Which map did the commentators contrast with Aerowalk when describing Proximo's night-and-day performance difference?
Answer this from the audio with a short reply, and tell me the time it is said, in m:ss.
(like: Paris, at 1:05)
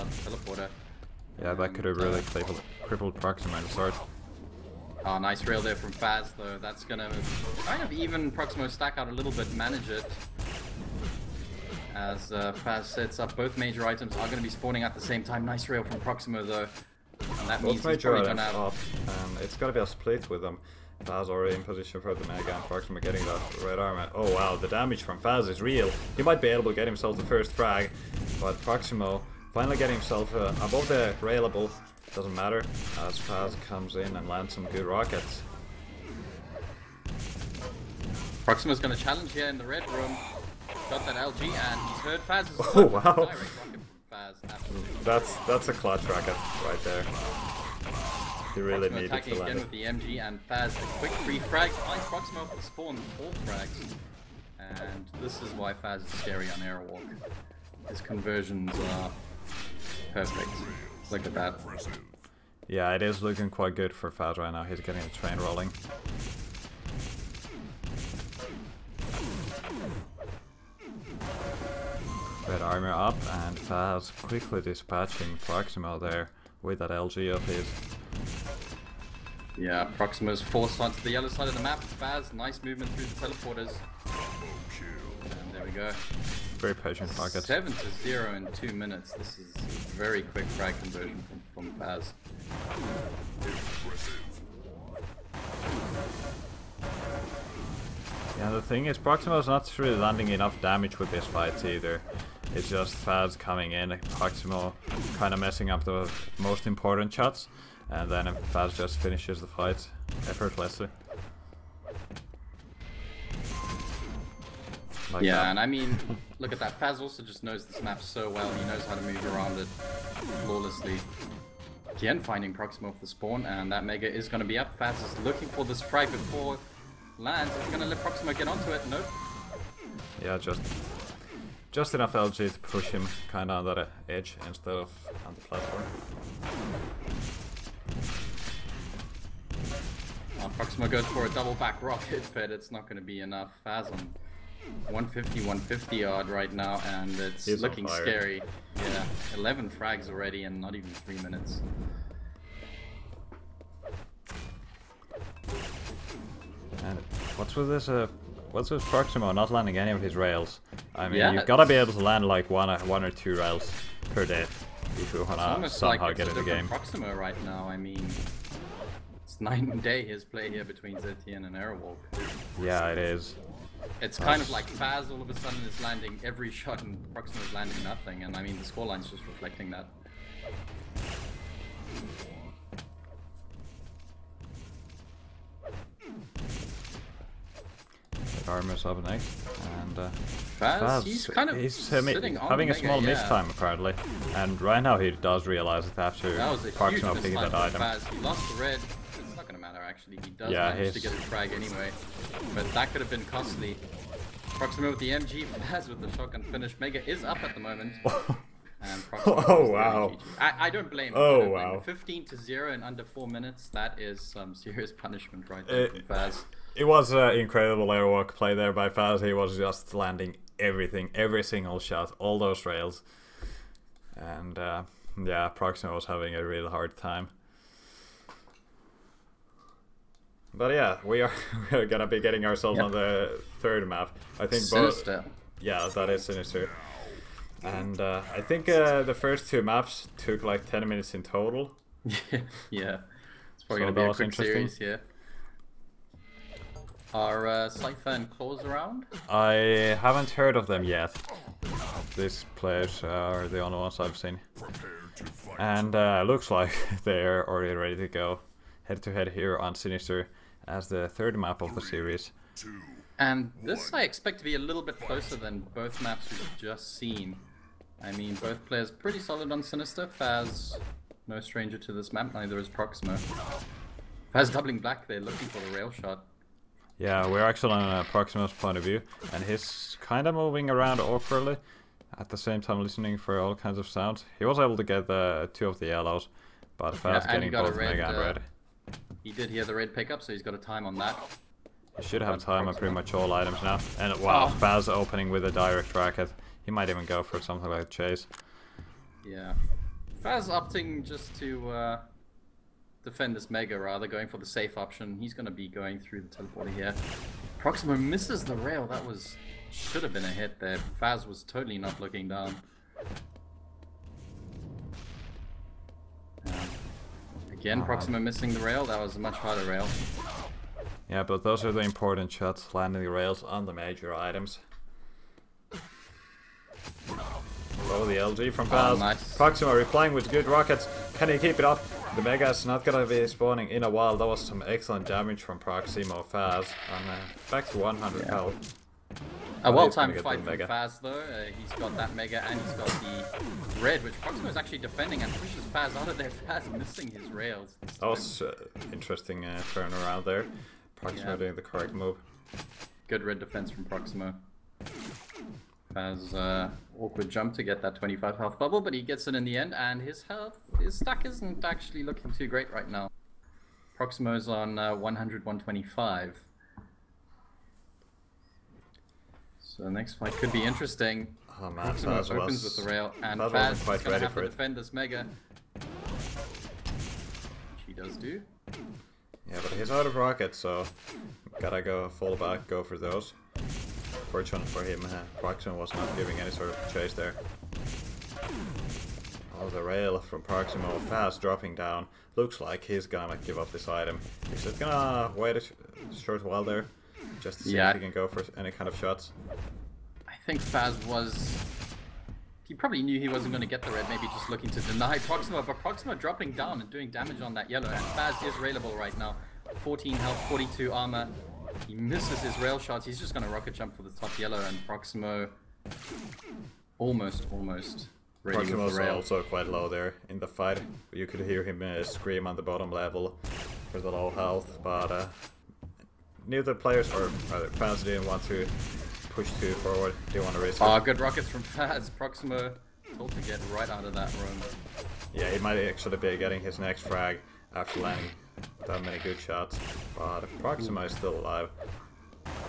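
ZTN, at 2:50.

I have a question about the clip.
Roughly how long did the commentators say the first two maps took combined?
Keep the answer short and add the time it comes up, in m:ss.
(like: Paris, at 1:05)
10 minutes, at 4:00.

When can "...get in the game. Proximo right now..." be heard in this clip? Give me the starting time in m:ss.
2:46.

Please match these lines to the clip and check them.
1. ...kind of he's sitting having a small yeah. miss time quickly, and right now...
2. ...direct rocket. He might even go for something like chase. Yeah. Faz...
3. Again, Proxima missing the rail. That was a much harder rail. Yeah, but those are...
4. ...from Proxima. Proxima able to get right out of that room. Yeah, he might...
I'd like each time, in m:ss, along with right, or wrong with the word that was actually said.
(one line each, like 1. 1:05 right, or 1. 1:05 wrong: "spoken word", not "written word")
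1. 3:11 wrong: "apparently", not "quickly"
2. 4:55 right
3. 5:17 right
4. 7:11 wrong: "Faz", not "Proxima".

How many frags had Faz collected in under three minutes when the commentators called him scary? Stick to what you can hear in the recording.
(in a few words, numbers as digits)
11.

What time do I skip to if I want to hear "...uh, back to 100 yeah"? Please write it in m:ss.
5:37.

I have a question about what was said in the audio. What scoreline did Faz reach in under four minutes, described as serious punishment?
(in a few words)
15 to 0.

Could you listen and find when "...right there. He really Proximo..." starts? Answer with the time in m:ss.
0:46.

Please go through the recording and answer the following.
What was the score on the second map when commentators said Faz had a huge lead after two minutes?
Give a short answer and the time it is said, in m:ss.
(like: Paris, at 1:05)
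7 to 0, at 1:27.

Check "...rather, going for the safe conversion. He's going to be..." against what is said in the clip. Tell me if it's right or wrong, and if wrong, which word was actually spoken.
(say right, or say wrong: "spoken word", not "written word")
wrong: "option", not "conversion".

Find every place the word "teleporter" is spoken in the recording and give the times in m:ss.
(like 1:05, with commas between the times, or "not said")
0:00, 1:23, 5:06.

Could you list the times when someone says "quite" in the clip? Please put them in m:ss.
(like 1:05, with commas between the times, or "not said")
1:03, 6:59.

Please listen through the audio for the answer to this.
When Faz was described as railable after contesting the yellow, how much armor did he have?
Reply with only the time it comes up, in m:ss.
6:50.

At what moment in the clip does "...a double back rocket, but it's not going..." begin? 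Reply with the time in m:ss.
2:21.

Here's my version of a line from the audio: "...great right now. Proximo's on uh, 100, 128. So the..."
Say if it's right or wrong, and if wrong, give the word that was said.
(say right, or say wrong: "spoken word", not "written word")
wrong: "125", not "128".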